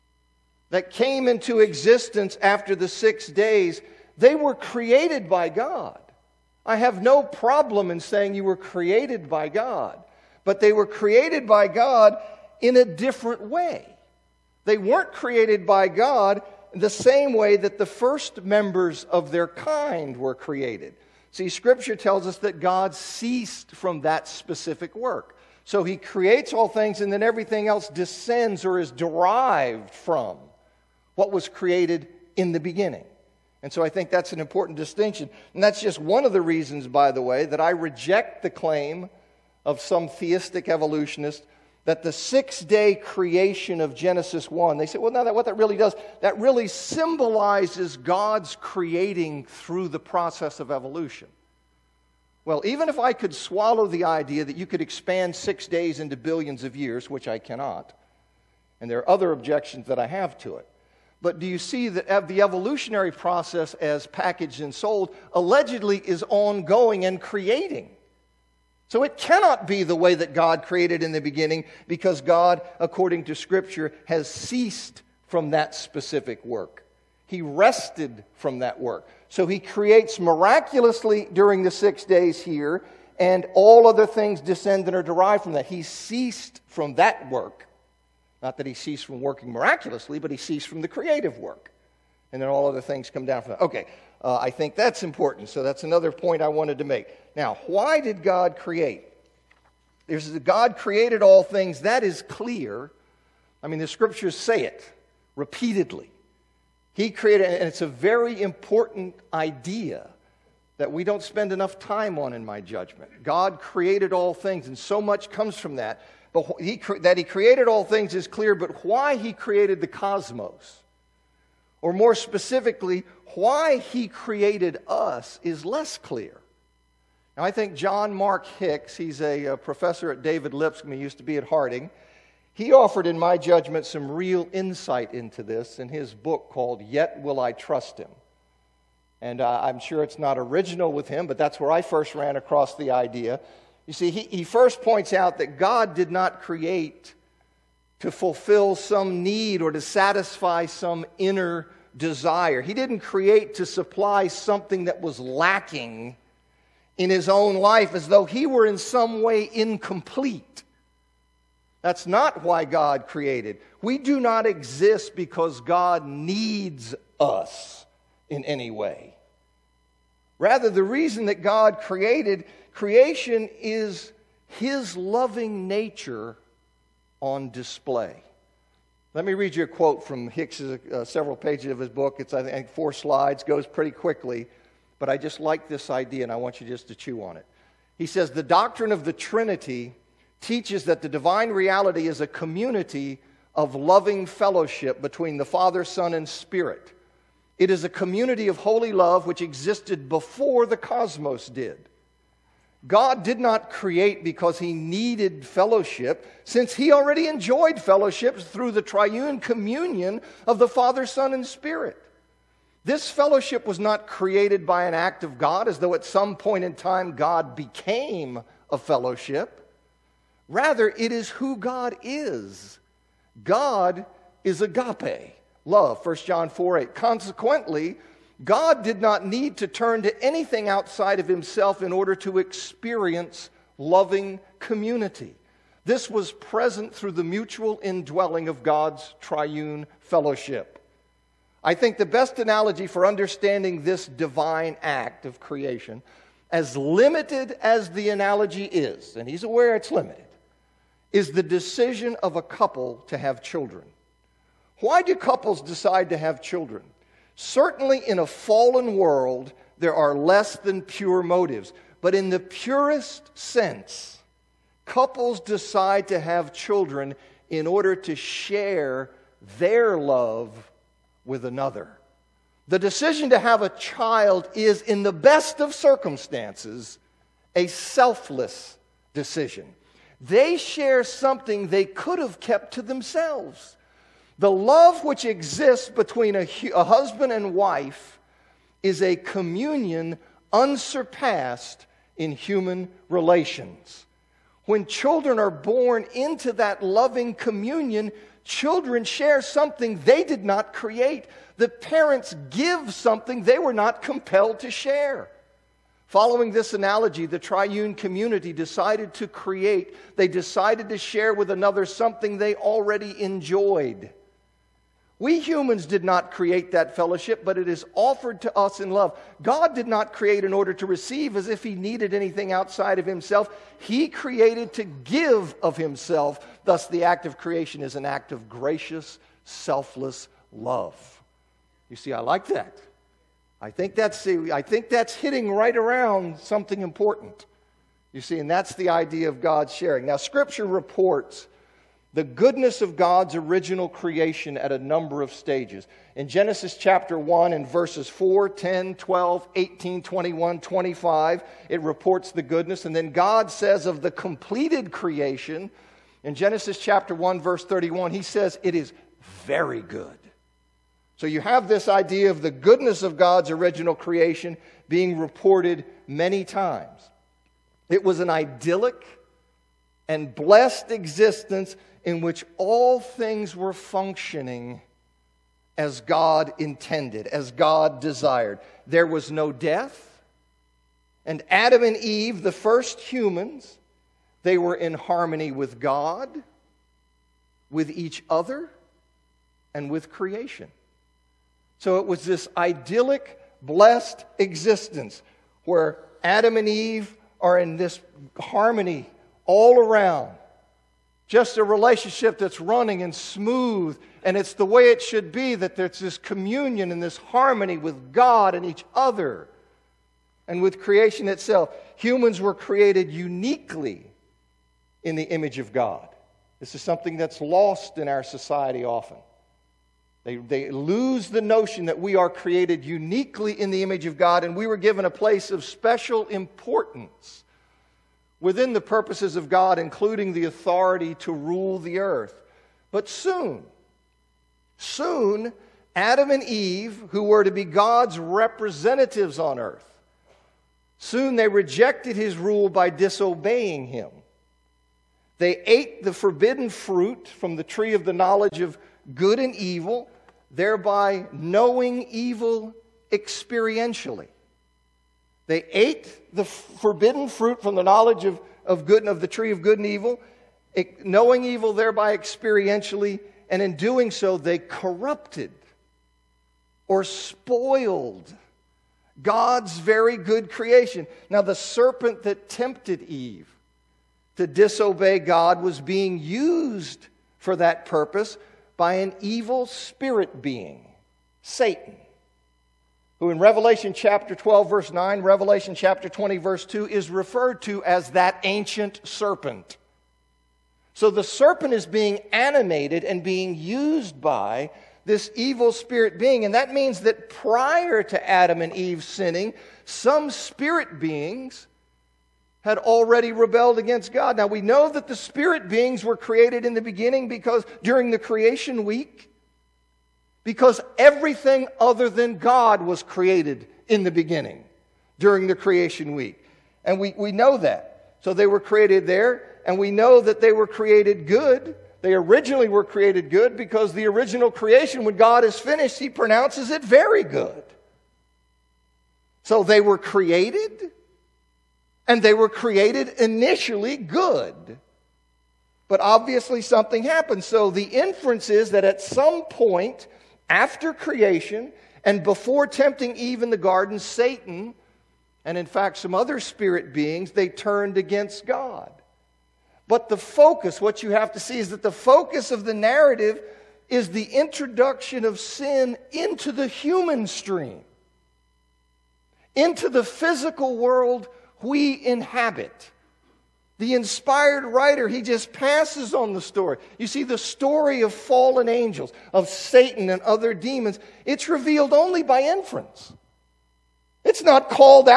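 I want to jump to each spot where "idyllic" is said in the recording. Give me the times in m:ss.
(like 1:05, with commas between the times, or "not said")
6:08, 6:32.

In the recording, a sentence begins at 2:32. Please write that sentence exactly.
He didn't create to supply something that was lacking in his own life as though he were in some way incomplete.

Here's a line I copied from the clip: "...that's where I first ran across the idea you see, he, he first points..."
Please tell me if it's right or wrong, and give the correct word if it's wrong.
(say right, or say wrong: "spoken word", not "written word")
right.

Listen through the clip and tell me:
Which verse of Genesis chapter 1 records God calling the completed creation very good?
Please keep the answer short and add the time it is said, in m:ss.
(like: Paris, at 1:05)
verse 31, at 5:57.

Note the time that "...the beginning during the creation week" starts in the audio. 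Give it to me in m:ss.
8:34.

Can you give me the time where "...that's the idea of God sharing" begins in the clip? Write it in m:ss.
5:38.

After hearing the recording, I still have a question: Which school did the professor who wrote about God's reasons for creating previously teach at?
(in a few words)
Harding.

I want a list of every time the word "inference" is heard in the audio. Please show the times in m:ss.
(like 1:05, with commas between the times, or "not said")
8:57, 9:32.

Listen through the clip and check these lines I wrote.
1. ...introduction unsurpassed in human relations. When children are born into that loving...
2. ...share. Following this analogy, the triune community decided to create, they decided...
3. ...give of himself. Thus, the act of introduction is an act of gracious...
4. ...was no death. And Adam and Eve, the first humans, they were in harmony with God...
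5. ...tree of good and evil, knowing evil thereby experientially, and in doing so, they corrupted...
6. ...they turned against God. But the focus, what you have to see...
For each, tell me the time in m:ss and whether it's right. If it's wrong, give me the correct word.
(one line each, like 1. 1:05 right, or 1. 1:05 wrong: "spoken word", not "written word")
1. 4:49 wrong: "communion", not "introduction"
2. 5:04 right
3. 5:24 wrong: "creation", not "introduction"
4. 6:19 right
5. 7:39 right
6. 9:07 right.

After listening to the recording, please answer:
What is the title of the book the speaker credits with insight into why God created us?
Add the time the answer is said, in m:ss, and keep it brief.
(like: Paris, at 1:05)
Yet Will I Trust Him, at 2:16.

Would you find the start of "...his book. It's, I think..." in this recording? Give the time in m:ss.
3:01.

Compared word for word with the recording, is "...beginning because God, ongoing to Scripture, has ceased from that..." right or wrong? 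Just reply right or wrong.
wrong.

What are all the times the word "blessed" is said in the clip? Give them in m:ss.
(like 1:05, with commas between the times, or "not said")
6:10, 6:33.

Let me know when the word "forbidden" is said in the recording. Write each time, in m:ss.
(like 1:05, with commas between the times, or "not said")
7:26, 7:36.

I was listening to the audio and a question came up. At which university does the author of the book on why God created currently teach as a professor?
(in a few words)
David Lipscomb.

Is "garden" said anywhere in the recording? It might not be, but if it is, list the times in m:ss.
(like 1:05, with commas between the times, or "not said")
9:03.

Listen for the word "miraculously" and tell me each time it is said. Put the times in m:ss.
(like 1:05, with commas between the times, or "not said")
1:20, 1:29.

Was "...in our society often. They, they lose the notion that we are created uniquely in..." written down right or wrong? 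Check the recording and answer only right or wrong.
right.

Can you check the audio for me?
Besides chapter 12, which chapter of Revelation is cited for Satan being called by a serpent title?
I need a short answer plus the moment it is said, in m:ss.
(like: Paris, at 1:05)
chapter 20, at 8:05.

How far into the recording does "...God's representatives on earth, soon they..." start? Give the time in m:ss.
7:17.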